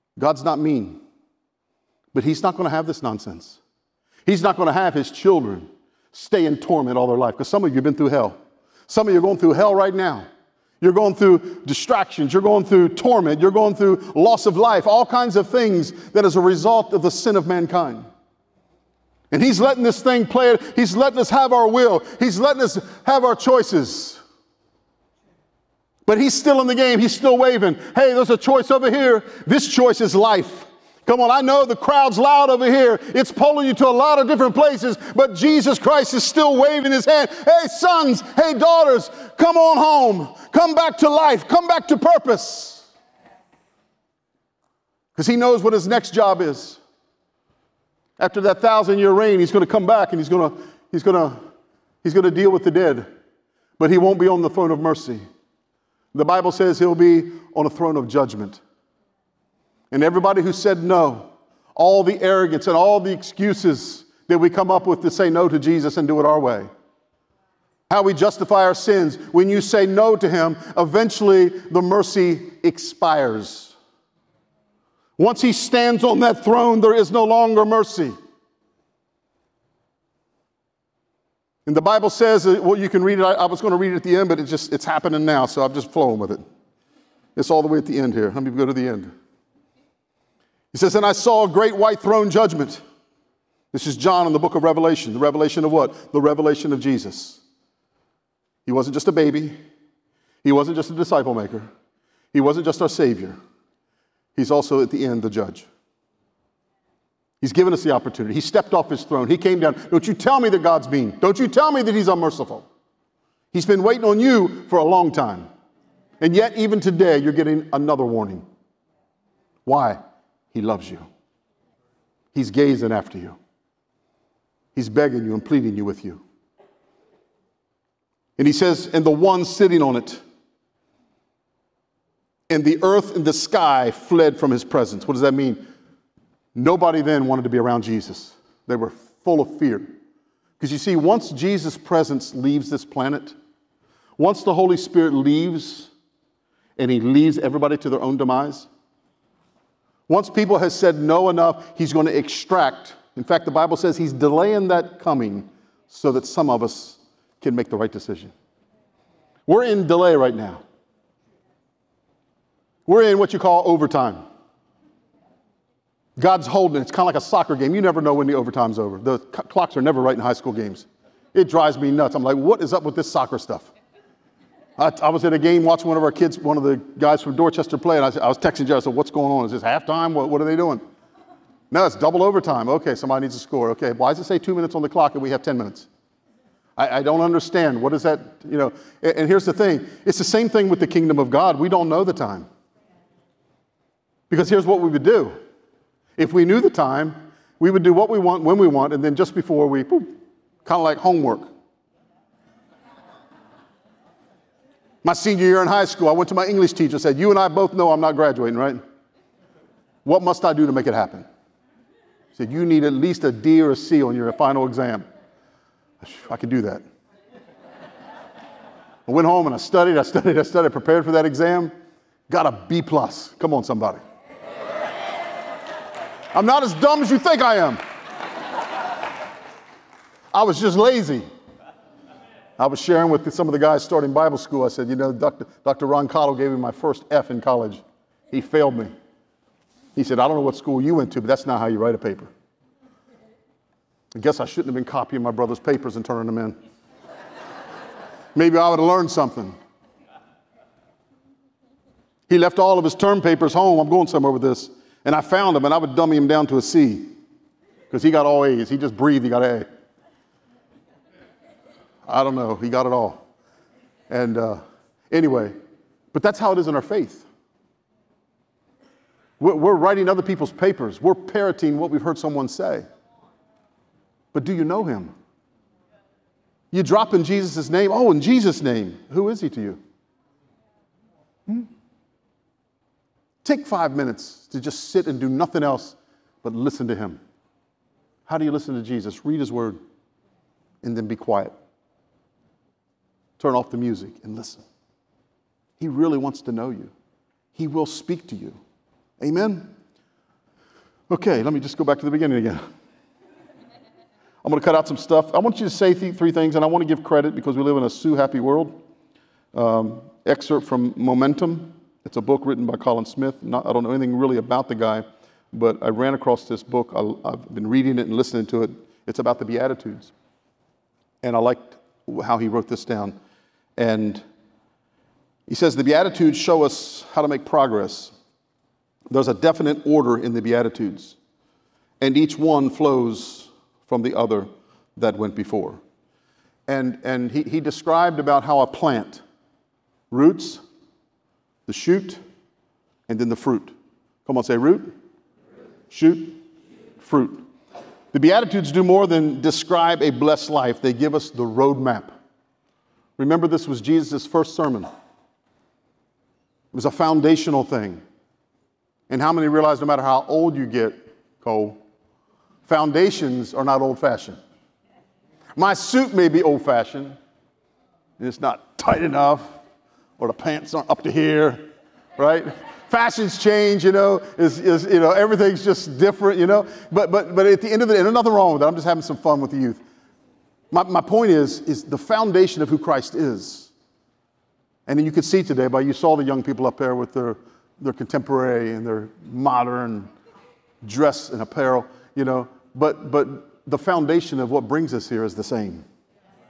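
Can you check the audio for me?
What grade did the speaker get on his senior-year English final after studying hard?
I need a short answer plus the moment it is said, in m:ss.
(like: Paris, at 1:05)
B plus, at 3:42.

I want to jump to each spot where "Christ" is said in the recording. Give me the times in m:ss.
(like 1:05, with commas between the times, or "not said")
0:35, 6:22.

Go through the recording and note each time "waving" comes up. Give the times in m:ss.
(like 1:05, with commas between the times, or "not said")
0:27, 0:36.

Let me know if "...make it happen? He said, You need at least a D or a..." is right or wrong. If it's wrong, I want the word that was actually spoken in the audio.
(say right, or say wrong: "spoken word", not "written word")
right.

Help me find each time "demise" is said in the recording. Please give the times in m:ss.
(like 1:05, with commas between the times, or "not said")
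2:28.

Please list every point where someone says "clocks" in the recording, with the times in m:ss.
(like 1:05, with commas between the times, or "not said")
2:49, 3:04.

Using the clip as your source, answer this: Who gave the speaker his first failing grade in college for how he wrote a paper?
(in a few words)
Dr. Ron Cottle.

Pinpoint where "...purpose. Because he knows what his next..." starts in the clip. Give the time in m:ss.
0:41.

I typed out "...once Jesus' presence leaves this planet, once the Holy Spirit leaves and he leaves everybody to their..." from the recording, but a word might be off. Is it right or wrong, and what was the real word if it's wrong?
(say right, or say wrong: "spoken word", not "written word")
right.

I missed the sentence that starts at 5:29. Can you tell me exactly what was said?
There's a definite order in the Beatitudes, and each one flows from the other that went before.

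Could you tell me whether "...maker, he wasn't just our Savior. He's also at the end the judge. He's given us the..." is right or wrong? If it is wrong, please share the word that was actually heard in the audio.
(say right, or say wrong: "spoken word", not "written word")
right.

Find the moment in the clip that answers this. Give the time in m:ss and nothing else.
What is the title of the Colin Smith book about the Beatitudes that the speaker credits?
5:10.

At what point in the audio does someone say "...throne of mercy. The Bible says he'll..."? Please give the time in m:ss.
0:54.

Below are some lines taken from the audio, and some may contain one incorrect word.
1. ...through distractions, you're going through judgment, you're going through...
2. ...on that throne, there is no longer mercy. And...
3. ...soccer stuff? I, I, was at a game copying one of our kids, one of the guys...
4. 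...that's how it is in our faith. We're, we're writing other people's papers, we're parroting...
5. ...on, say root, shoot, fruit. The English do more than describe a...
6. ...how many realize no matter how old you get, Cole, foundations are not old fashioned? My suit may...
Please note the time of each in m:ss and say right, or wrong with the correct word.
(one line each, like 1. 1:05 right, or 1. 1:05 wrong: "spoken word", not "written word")
1. 0:11 wrong: "torment", not "judgment"
2. 1:16 right
3. 2:53 wrong: "watching", not "copying"
4. 4:26 right
5. 5:44 wrong: "Beatitudes", not "English"
6. 5:59 right.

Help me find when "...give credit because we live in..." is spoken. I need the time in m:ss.
5:06.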